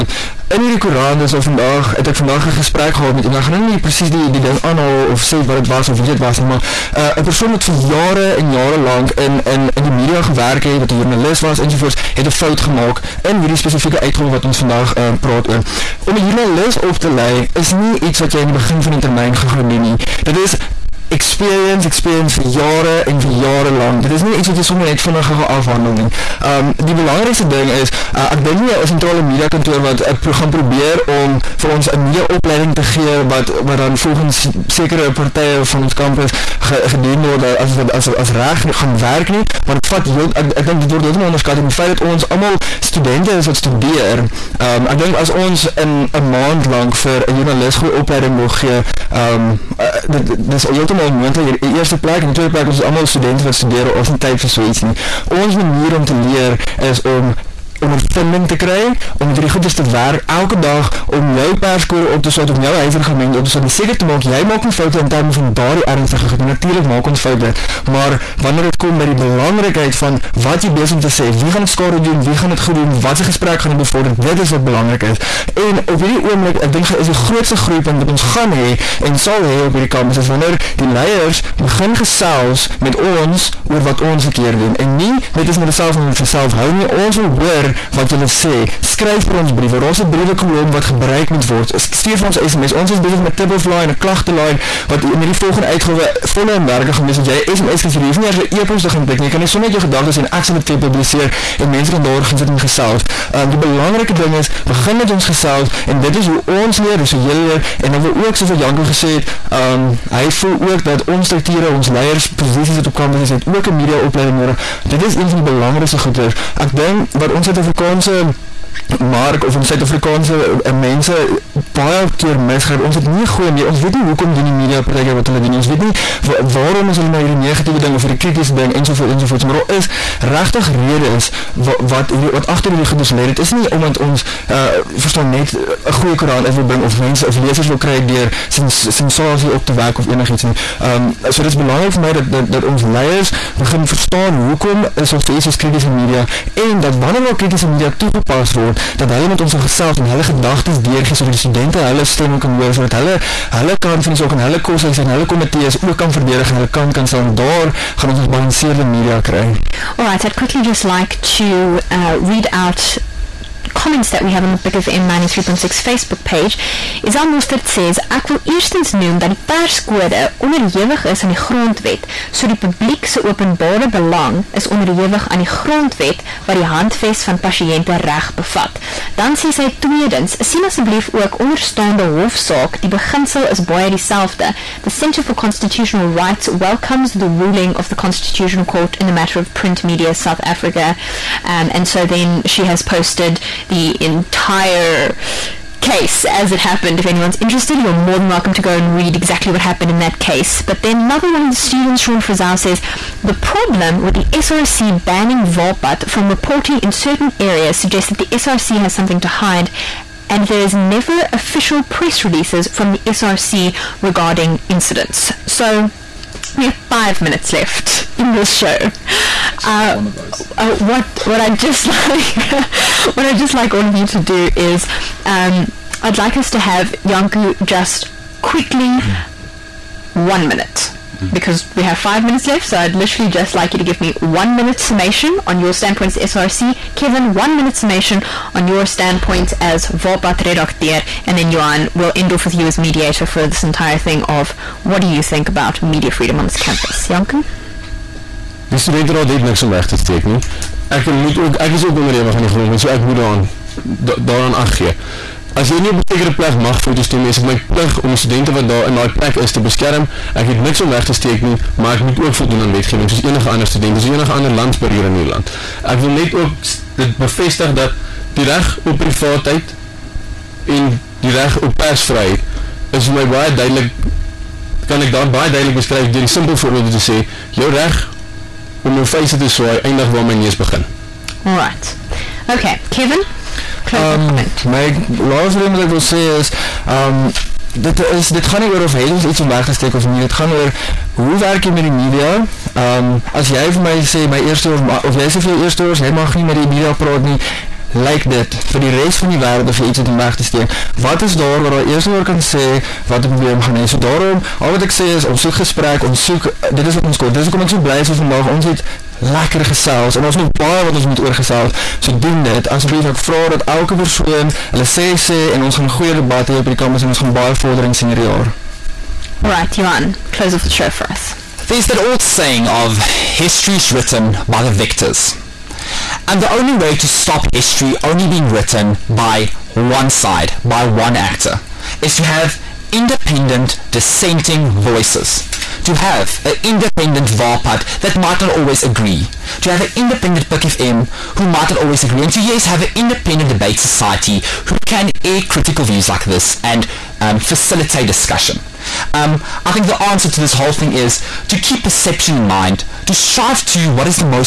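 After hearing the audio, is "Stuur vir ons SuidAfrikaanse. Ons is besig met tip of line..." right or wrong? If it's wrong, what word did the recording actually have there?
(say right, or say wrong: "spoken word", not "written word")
wrong: "SMS", not "SuidAfrikaanse".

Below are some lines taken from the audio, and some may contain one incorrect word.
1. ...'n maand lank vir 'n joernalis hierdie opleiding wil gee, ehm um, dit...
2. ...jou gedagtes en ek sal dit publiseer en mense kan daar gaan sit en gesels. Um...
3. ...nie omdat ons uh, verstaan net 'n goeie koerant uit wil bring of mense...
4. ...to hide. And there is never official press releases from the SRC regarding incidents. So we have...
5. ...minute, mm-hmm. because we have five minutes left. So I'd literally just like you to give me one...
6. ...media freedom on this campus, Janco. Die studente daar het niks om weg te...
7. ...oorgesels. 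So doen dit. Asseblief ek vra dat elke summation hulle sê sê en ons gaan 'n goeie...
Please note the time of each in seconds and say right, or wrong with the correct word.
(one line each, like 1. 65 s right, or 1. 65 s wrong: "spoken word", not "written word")
1. 46 s wrong: "goeie", not "hierdie"
2. 99 s right
3. 133 s right
4. 209 s right
5. 230 s right
6. 245 s right
7. 311 s wrong: "persoon", not "summation".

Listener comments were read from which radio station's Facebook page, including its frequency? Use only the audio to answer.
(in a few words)
PUK FM93.6.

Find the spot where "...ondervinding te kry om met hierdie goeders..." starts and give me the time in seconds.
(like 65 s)
57 s.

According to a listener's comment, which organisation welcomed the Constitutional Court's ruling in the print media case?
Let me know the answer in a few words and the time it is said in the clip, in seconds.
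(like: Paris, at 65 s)
Centre for Constitutional Rights, at 184 s.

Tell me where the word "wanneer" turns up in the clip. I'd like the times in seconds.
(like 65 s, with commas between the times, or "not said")
68 s, 80 s, 146 s.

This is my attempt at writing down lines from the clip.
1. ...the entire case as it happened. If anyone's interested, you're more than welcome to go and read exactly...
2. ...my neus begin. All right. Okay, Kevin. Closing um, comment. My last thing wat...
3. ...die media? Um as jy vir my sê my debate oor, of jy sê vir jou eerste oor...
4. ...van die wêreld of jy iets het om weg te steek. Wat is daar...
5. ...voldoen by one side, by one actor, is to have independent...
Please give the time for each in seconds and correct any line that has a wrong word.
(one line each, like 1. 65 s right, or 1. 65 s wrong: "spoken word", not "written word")
1. 193 s right
2. 280 s right
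3. 291 s wrong: "eerste", not "debate"
4. 299 s right
5. 328 s wrong: "written", not "voldoen".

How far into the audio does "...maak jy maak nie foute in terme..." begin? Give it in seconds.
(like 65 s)
64 s.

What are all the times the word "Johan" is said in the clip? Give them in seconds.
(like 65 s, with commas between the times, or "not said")
241 s, 319 s.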